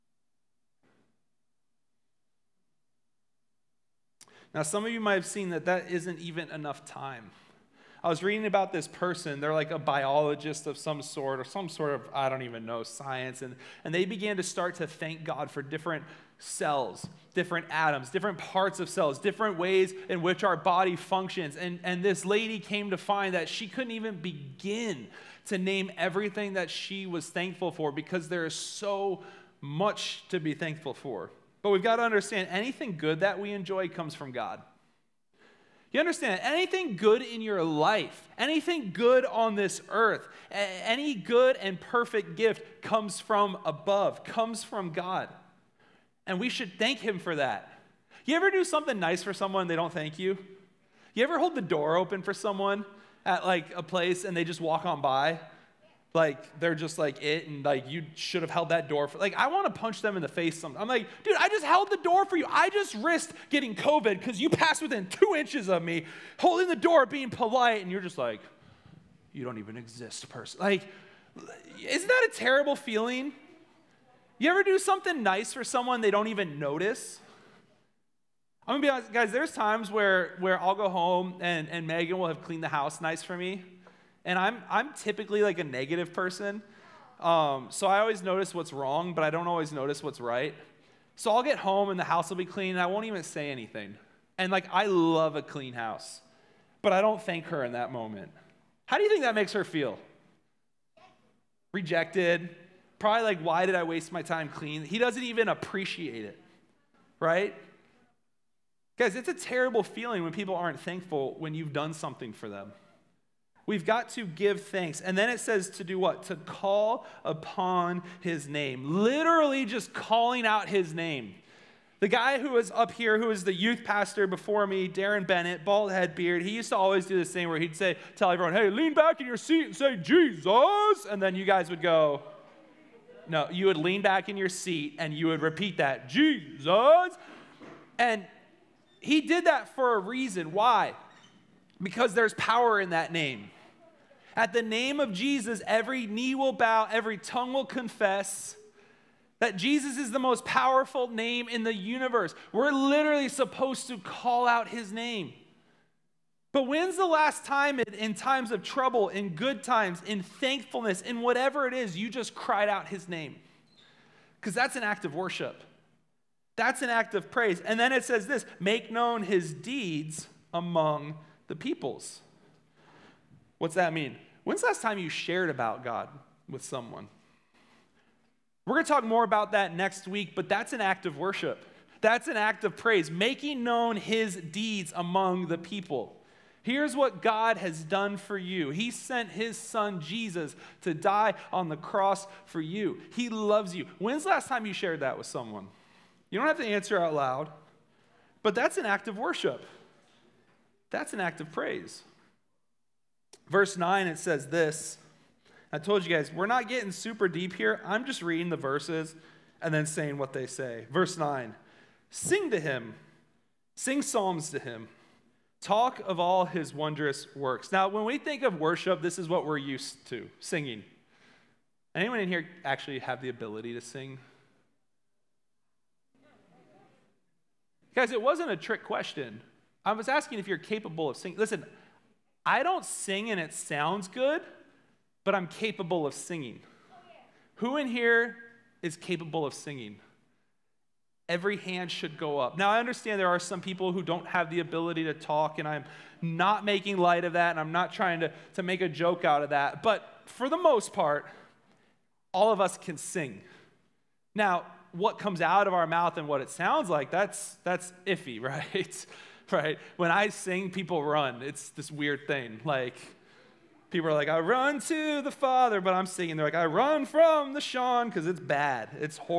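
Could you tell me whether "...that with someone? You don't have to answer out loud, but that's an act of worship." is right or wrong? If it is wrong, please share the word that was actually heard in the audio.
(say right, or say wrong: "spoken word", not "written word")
right.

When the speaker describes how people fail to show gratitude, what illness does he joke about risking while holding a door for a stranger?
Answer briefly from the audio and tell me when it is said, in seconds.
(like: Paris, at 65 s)
COVID, at 63 s.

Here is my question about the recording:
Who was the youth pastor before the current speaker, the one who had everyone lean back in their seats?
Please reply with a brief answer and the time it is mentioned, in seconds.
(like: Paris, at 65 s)
Darren Bennett, at 124 s.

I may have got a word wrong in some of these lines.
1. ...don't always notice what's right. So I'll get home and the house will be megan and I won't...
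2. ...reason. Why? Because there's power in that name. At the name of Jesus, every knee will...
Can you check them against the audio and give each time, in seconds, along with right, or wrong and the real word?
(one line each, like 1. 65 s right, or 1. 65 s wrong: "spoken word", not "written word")
1. 89 s wrong: "clean", not "megan"
2. 139 s right.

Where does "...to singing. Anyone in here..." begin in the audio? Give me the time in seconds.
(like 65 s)
220 s.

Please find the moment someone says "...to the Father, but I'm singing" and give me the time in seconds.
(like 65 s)
264 s.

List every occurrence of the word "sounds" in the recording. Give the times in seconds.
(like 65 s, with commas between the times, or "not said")
233 s, 256 s.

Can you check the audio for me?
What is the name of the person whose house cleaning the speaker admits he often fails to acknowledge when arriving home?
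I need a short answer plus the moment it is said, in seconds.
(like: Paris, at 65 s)
Megan, at 81 s.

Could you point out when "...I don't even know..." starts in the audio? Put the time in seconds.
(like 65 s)
12 s.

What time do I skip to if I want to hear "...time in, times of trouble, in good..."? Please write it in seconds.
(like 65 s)
157 s.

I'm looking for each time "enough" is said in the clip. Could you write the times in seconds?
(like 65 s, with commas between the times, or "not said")
6 s.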